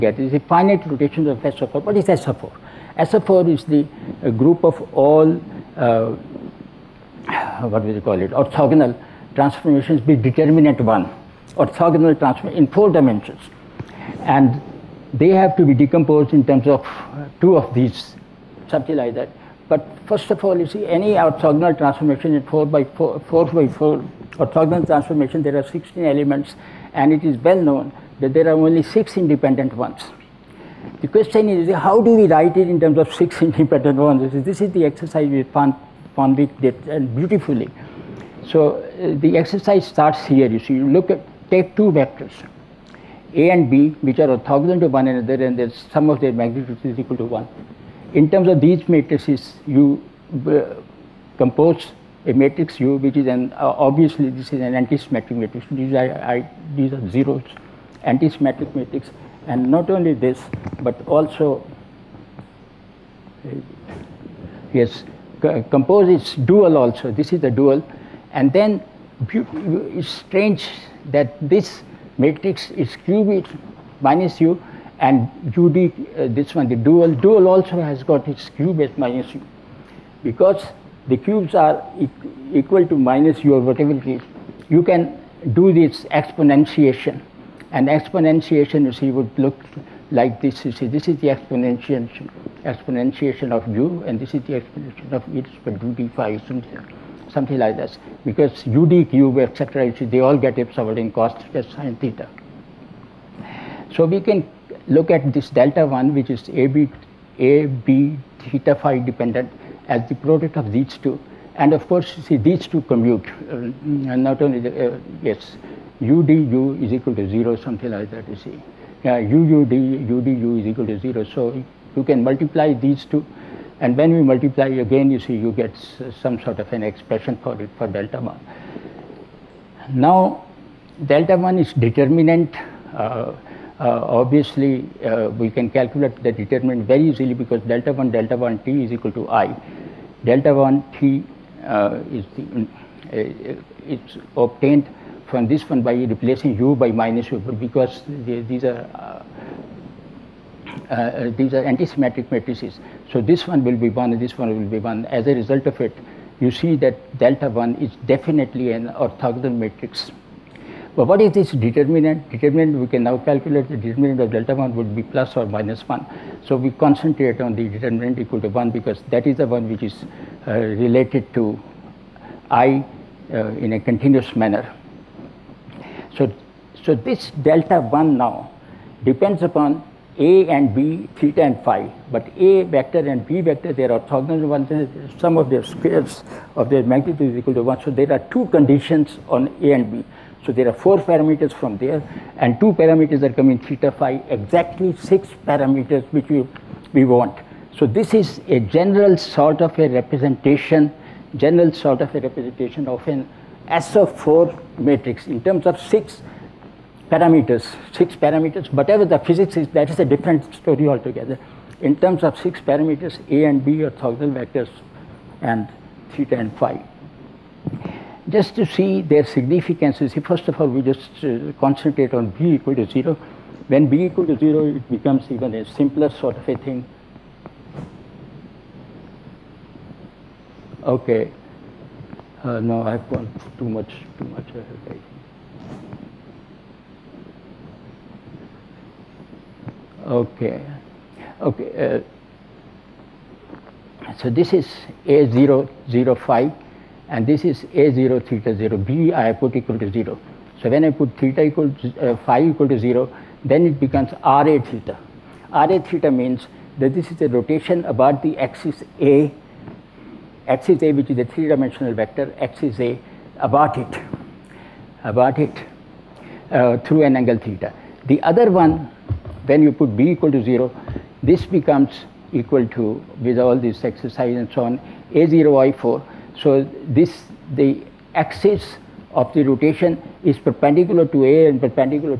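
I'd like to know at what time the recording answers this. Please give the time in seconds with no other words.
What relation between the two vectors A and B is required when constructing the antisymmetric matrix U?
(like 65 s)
44 s.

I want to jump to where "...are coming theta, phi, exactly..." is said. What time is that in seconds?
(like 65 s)
193 s.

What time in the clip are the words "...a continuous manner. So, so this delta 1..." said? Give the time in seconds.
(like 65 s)
173 s.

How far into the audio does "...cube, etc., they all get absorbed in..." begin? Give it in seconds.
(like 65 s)
99 s.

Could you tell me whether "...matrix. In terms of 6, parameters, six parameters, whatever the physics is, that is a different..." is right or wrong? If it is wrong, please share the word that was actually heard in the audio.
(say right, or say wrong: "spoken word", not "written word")
right.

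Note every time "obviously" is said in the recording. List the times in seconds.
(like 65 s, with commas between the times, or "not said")
53 s, 134 s.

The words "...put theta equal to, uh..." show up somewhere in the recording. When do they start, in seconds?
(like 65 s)
250 s.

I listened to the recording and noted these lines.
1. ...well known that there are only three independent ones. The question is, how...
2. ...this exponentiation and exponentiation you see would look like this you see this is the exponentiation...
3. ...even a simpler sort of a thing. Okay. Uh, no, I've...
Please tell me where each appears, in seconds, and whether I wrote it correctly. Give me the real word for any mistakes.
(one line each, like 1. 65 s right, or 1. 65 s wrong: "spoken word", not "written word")
1. 27 s wrong: "six", not "three"
2. 85 s right
3. 225 s right.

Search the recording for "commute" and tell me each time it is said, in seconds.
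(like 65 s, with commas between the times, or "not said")
112 s.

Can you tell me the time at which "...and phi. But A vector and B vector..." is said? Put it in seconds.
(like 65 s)
181 s.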